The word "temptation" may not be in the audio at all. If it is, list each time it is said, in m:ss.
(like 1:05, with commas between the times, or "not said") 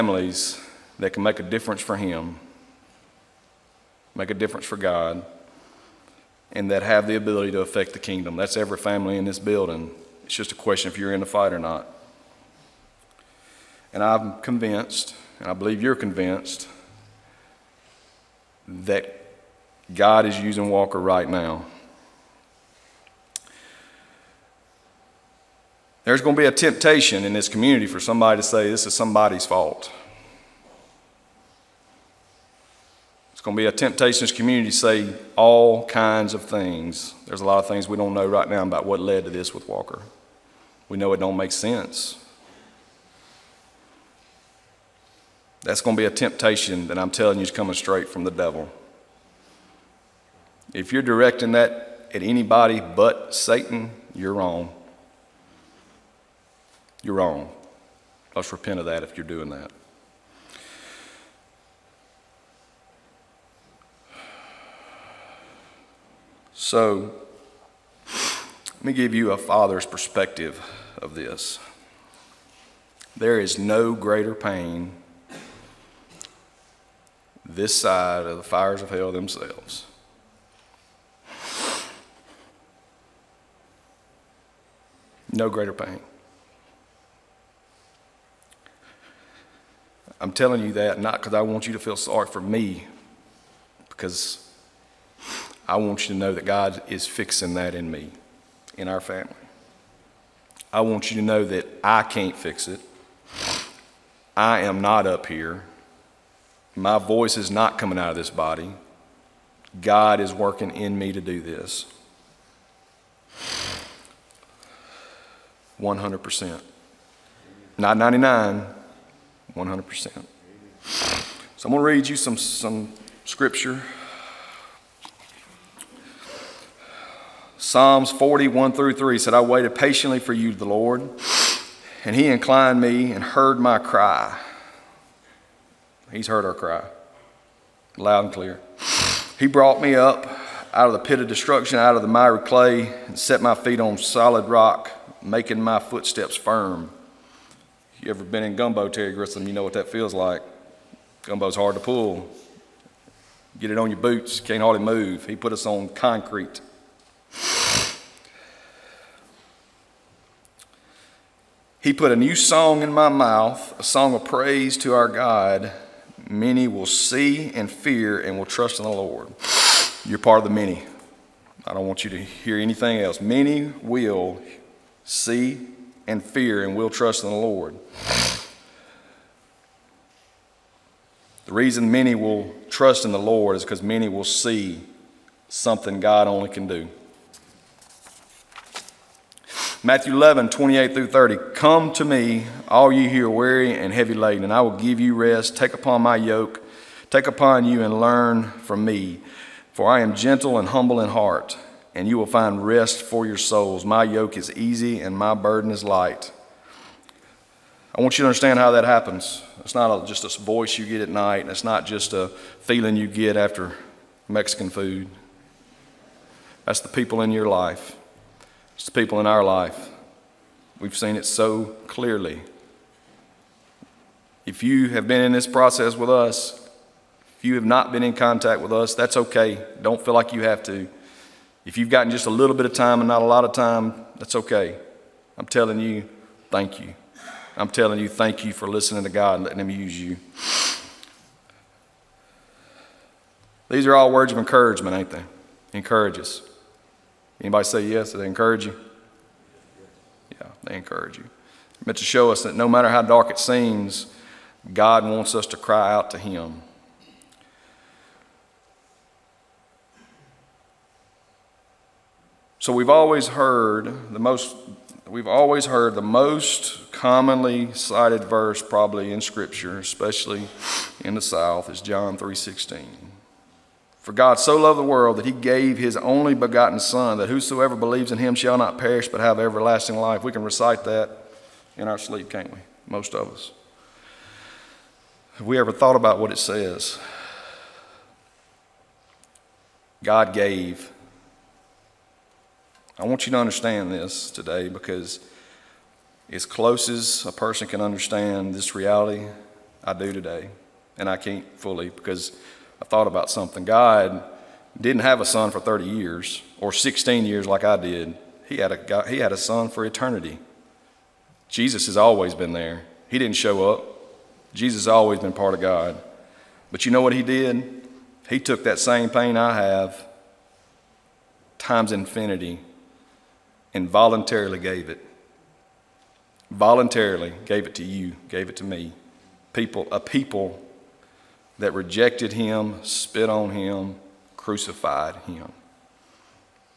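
0:26, 0:33, 0:46.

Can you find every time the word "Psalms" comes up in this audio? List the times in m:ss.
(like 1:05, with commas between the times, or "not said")
2:07.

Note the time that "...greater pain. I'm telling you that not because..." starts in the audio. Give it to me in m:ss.
1:25.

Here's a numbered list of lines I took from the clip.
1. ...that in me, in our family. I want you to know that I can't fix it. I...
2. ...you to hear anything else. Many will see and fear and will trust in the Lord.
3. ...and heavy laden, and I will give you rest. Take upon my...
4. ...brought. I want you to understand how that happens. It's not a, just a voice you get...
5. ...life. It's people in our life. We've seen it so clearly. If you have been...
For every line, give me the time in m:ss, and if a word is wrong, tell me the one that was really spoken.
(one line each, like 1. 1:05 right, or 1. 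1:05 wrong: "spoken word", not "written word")
1. 1:37 right
2. 2:52 right
3. 3:13 right
4. 3:25 wrong: "light", not "brought"
5. 3:37 right.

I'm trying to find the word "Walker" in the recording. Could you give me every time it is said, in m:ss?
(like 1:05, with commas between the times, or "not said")
0:20, 0:39.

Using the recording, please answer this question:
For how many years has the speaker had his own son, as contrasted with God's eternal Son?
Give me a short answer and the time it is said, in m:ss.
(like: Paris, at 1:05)
16, at 5:06.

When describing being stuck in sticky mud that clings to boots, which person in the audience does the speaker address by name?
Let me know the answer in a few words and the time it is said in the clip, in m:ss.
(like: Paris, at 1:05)
Terry Grissom, at 2:28.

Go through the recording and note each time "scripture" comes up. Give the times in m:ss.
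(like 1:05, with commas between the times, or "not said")
2:03, 4:29.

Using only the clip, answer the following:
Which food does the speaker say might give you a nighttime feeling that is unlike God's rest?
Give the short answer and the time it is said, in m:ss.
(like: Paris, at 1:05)
Mexican food, at 3:34.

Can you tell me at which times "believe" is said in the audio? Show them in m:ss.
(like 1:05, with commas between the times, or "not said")
0:15, 4:37.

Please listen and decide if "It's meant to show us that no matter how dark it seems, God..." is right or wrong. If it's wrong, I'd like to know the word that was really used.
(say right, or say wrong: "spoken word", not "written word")
right.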